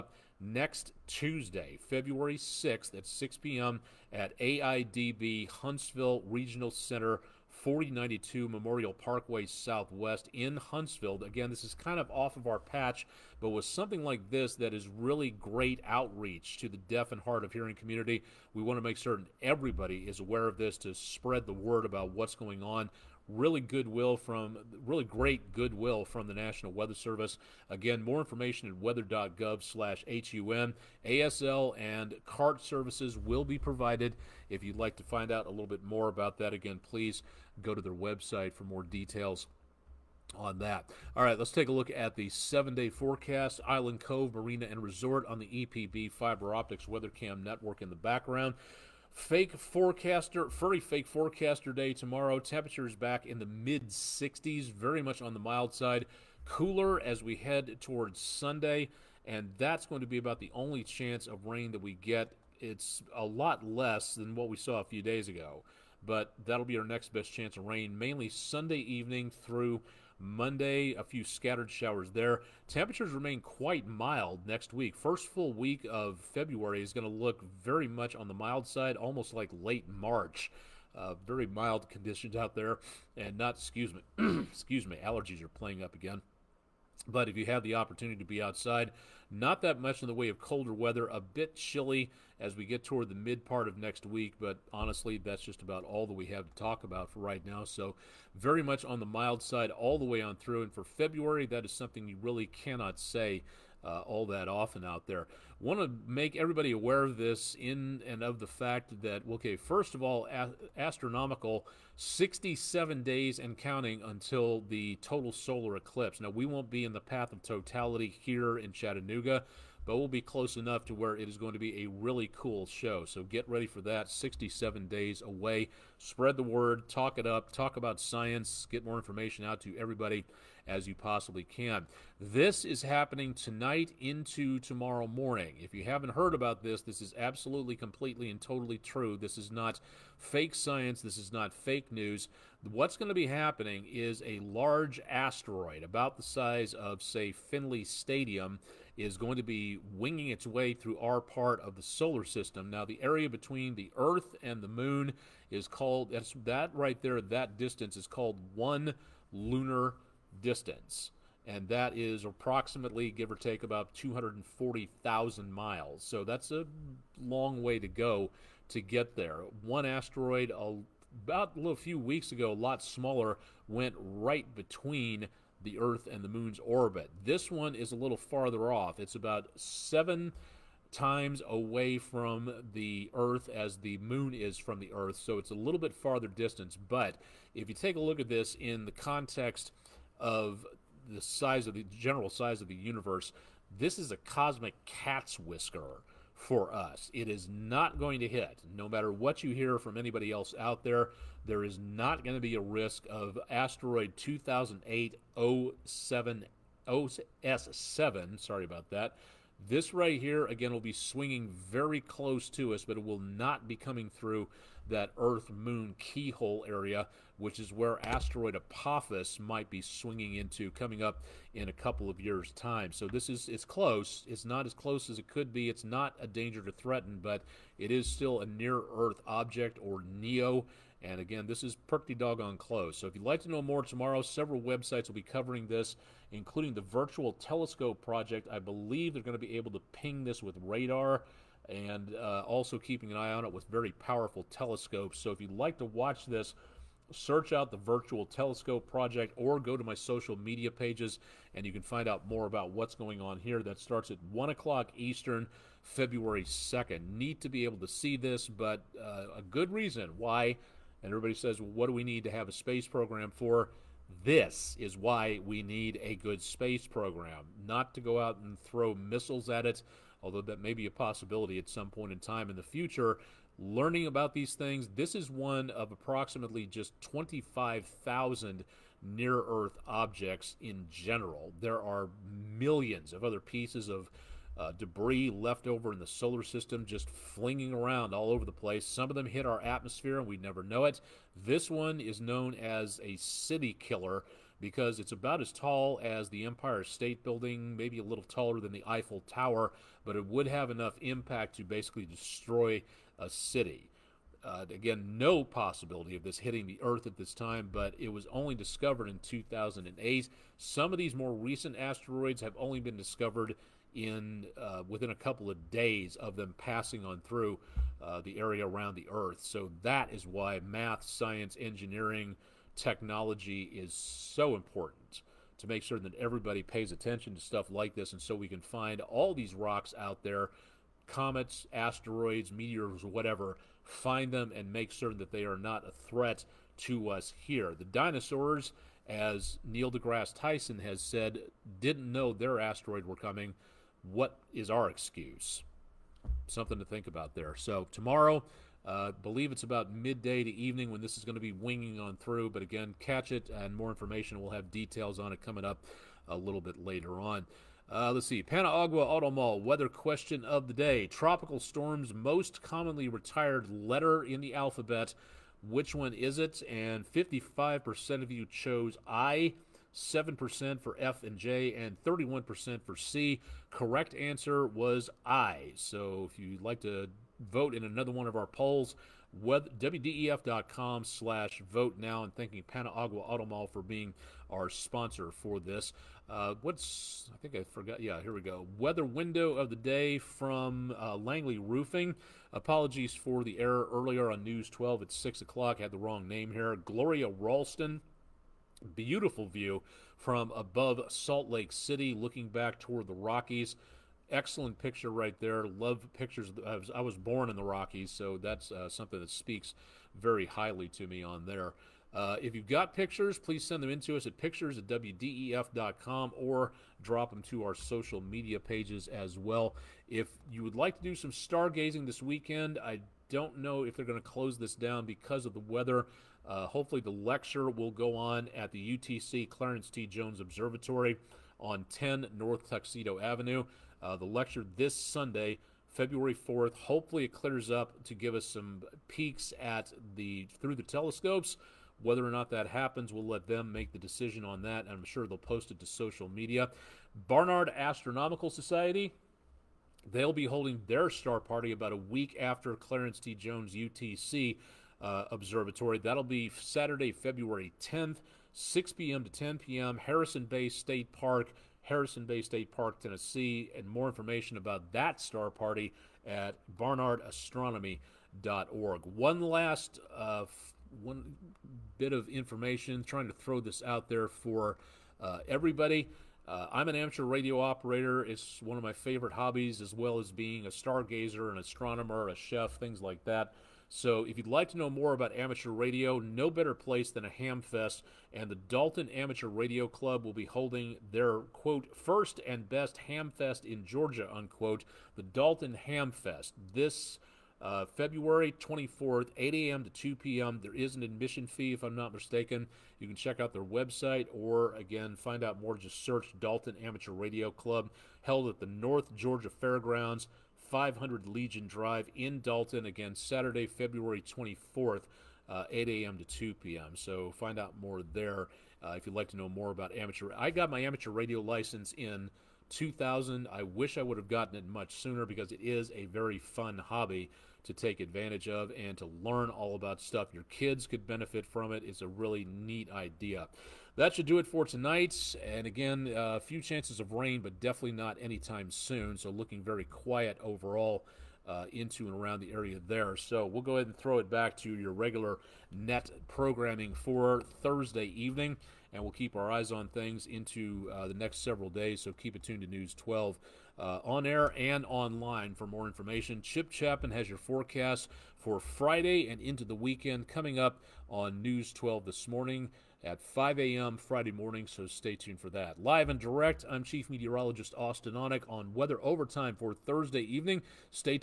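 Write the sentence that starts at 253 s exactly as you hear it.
That starts at 1 o'clock Eastern, February 2nd.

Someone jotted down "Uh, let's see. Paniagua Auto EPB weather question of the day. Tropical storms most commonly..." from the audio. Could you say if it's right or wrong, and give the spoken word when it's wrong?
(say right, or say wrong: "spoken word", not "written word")
wrong: "Mall", not "EPB".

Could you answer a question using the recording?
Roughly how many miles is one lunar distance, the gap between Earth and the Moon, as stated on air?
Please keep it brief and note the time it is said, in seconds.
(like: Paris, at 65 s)
240,000 miles, at 163 s.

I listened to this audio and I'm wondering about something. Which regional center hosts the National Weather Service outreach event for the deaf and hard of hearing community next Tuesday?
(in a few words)
AIDB Huntsville Regional Center.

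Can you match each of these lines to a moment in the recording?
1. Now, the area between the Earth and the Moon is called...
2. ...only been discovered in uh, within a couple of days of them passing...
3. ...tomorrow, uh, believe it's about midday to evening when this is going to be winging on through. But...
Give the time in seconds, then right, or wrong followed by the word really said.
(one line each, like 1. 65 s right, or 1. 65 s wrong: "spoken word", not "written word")
1. 152 s right
2. 312 s right
3. 347 s right.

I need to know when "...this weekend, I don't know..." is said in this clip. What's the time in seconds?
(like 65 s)
422 s.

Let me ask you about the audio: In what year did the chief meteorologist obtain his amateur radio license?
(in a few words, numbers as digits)
2000.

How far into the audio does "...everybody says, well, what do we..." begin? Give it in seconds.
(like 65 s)
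261 s.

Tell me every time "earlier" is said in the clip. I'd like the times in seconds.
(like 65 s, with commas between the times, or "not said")
393 s.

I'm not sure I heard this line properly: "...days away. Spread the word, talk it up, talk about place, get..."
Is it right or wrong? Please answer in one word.
wrong.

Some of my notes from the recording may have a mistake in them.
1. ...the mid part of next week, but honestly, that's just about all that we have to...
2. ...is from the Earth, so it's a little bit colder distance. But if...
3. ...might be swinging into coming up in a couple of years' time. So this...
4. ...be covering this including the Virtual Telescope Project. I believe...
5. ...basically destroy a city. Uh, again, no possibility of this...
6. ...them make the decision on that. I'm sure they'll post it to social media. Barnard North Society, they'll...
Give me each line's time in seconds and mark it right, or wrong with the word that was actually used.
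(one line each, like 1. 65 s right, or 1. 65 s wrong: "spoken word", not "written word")
1. 93 s right
2. 184 s wrong: "farther", not "colder"
3. 219 s right
4. 235 s right
5. 301 s right
6. 443 s wrong: "Astronomical", not "North".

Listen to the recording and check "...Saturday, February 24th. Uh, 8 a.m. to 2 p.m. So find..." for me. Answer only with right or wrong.
right.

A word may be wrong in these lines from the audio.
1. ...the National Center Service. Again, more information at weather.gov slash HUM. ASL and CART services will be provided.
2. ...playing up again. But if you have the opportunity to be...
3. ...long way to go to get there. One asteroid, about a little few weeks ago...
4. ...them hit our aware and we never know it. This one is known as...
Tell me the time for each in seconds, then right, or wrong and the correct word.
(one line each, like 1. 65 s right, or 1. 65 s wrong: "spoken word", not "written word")
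1. 26 s wrong: "Weather", not "Center"
2. 85 s right
3. 167 s right
4. 289 s wrong: "atmosphere", not "aware".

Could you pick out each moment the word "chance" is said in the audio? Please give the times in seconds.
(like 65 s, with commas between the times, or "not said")
60 s, 67 s, 536 s.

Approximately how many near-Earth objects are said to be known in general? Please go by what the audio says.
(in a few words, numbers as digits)
25,000.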